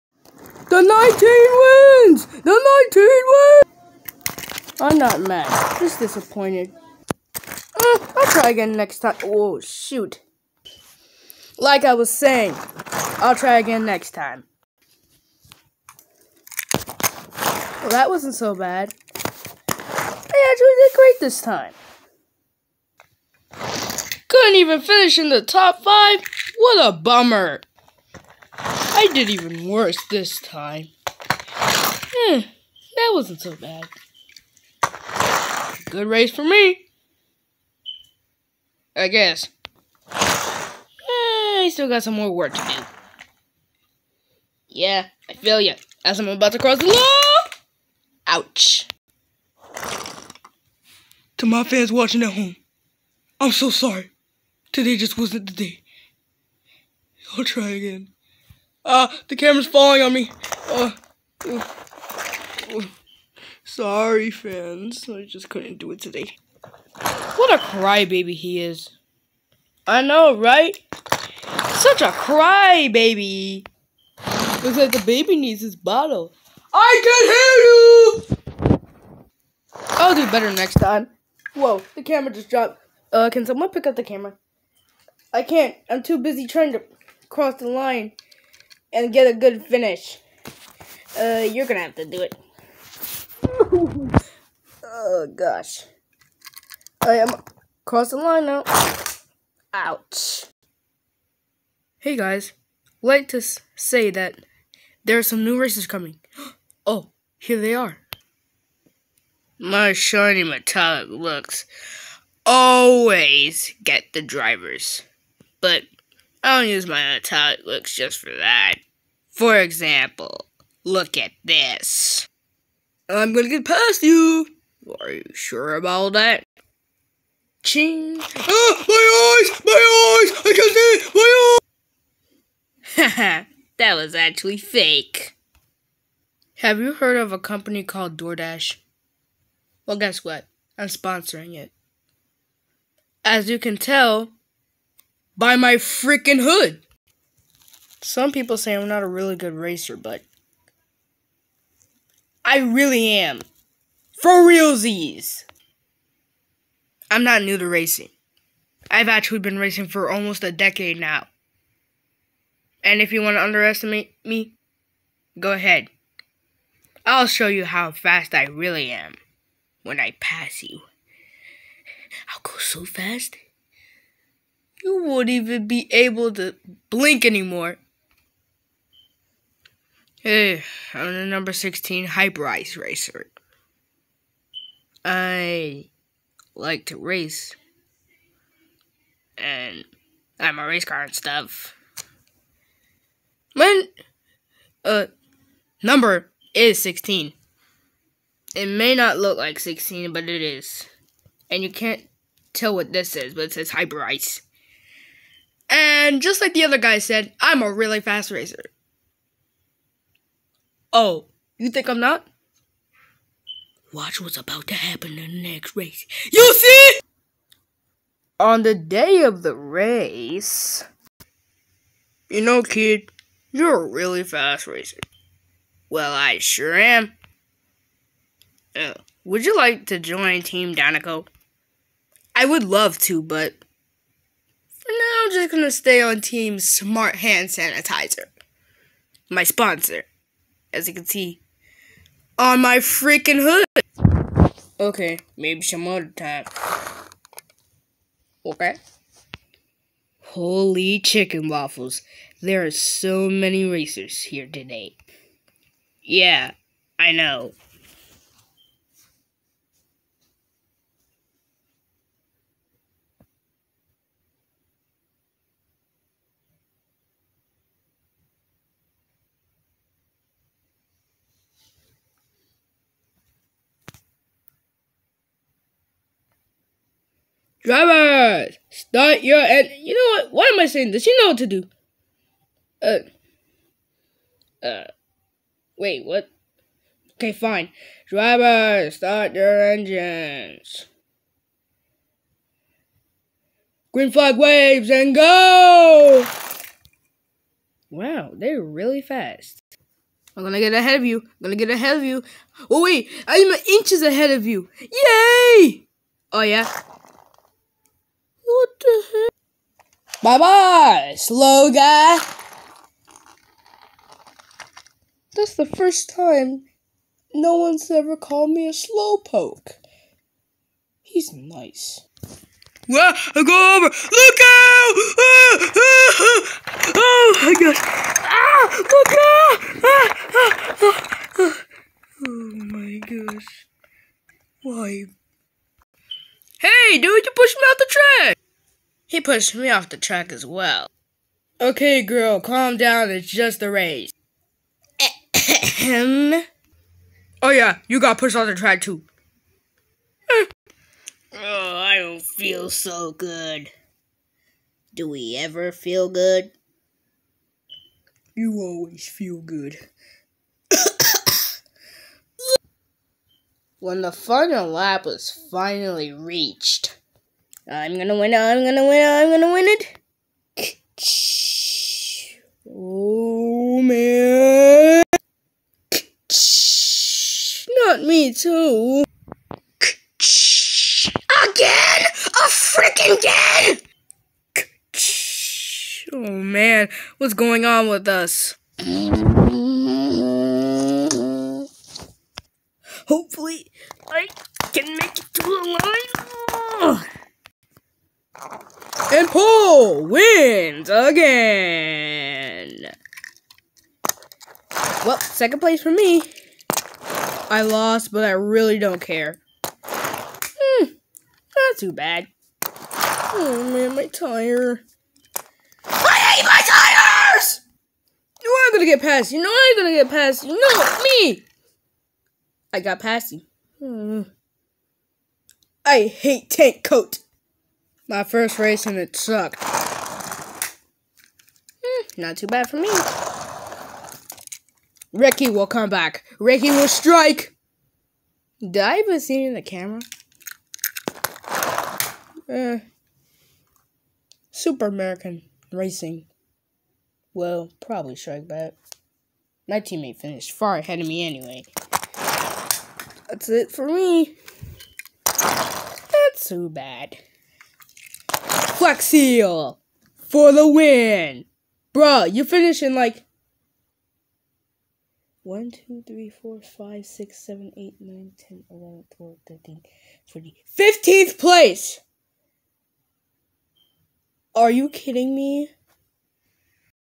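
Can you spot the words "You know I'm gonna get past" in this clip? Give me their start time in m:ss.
6:59.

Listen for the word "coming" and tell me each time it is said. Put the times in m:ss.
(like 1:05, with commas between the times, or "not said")
1:45.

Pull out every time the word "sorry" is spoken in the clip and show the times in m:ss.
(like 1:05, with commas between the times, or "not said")
0:53, 1:03.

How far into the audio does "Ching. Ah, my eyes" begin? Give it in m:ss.
2:07.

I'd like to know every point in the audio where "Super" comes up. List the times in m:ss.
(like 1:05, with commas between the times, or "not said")
7:24.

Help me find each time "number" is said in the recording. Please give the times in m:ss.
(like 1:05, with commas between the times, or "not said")
3:01, 3:15.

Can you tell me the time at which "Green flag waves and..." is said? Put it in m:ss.
4:53.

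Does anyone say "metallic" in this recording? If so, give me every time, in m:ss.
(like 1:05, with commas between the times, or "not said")
1:50.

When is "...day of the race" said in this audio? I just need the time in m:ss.
3:38.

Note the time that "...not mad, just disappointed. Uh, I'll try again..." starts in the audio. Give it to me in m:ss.
0:04.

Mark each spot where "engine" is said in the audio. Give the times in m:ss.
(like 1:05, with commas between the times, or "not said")
4:39, 4:49.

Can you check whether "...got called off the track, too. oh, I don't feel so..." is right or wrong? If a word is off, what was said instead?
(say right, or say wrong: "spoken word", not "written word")
wrong: "pushed", not "called".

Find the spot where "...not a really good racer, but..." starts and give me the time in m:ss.
2:28.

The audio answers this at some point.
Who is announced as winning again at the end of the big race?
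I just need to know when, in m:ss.
6:39.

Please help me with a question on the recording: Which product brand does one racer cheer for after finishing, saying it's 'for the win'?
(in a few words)
Flex Seal.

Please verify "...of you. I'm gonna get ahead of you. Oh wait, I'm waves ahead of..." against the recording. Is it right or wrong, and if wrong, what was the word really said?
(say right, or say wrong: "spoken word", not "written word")
wrong: "inches", not "waves".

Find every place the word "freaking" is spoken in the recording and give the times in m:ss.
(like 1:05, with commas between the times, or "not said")
2:25, 4:02, 6:22.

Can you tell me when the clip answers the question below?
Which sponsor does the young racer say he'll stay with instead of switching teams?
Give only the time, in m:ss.
3:56.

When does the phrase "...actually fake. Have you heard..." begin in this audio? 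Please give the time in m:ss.
2:14.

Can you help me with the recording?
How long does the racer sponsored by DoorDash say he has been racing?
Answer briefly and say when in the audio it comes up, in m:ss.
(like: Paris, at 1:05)
almost a decade, at 2:40.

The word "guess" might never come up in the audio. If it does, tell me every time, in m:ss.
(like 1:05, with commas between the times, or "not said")
0:39, 2:19.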